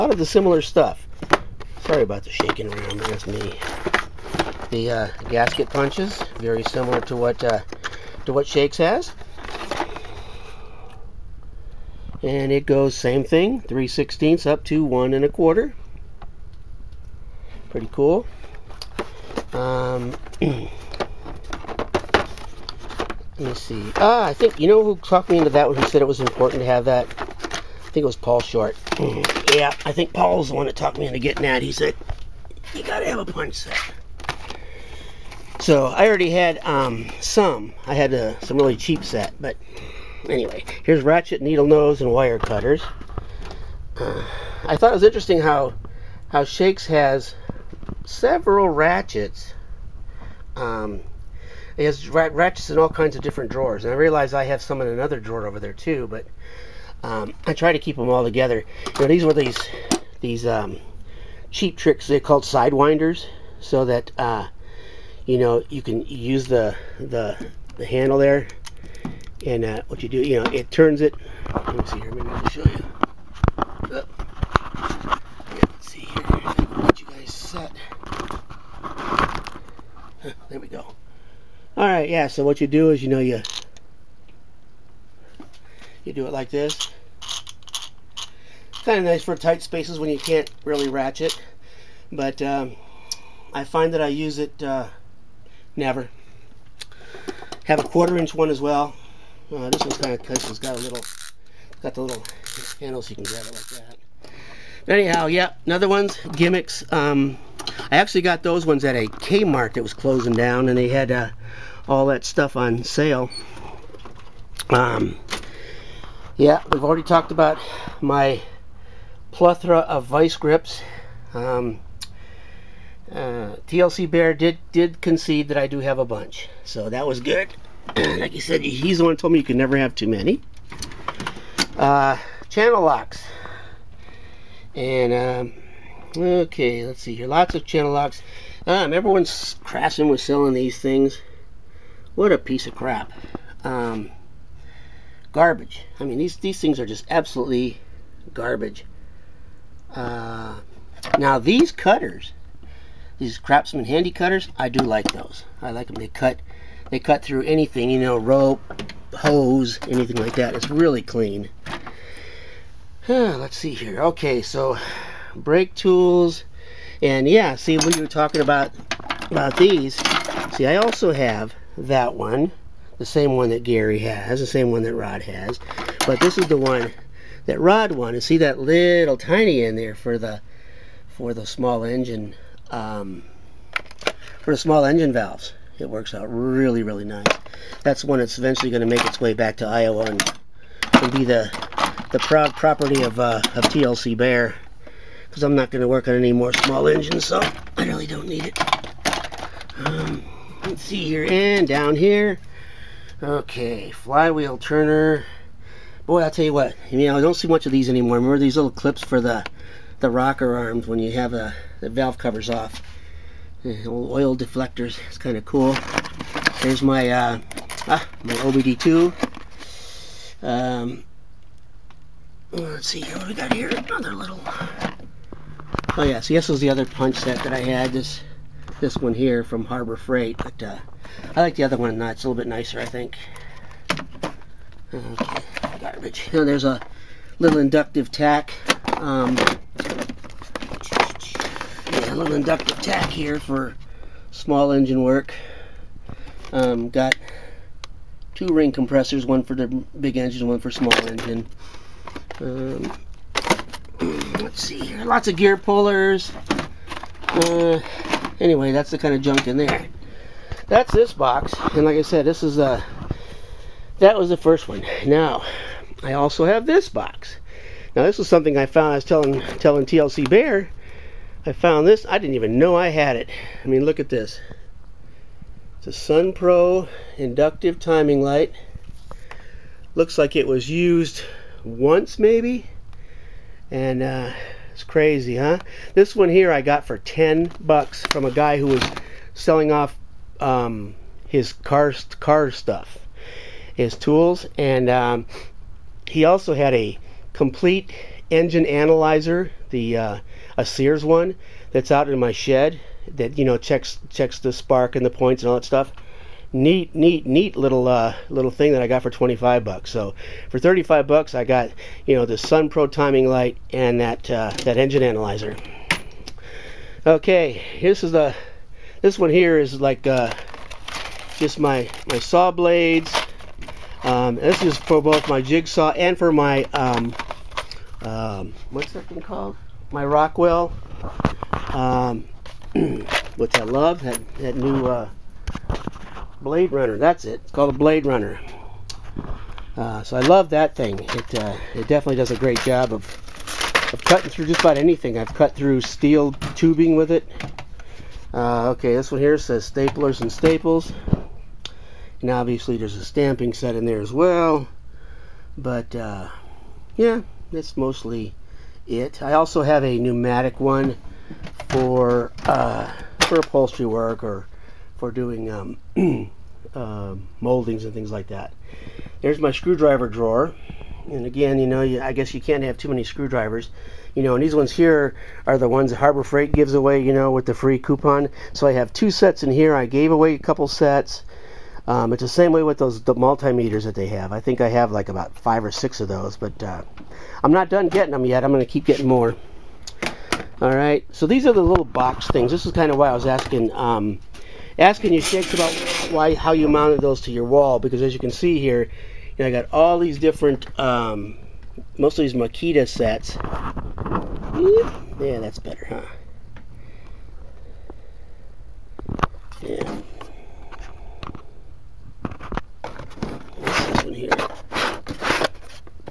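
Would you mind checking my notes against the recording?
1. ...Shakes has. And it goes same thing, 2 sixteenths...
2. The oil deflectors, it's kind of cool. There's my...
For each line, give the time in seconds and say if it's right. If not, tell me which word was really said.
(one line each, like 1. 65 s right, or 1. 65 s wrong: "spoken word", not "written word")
1. 8 s wrong: "3", not "2"
2. 213 s right.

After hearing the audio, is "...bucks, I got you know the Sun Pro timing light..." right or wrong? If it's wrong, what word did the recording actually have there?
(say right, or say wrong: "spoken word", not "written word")
right.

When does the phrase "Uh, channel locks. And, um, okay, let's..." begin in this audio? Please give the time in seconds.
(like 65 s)
131 s.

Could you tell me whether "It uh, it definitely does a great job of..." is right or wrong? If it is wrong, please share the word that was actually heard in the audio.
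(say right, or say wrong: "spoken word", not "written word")
right.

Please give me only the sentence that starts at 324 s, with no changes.
Um, this is for both my jigsaw and for my um, um, what's that thing called?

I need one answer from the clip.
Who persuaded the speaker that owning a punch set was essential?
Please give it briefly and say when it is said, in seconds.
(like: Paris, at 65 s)
Paul Short, at 28 s.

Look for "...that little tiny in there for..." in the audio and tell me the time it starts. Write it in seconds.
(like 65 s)
178 s.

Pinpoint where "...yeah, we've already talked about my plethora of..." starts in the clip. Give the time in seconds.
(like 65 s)
116 s.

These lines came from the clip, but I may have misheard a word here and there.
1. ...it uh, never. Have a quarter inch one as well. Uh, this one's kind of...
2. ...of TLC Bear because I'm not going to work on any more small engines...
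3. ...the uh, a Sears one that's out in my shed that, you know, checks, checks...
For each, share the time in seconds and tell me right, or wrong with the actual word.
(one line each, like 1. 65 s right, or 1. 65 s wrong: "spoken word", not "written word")
1. 94 s right
2. 193 s right
3. 299 s right.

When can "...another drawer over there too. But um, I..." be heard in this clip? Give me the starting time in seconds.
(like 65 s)
54 s.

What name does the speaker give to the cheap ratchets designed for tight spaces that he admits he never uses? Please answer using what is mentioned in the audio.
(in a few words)
sidewinders.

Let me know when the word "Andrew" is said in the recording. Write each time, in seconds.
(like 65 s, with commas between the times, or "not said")
not said.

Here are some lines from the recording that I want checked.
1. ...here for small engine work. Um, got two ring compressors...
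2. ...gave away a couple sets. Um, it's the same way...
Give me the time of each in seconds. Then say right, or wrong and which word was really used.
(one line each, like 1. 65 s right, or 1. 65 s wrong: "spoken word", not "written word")
1. 243 s right
2. 379 s right.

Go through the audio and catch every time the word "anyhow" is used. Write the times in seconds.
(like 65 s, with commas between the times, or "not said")
104 s.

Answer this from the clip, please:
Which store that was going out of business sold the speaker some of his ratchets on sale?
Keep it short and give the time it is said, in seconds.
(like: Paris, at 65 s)
Kmart, at 109 s.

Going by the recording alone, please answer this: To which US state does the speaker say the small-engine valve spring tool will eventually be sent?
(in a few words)
Iowa.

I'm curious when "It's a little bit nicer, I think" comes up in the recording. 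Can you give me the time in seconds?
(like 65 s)
232 s.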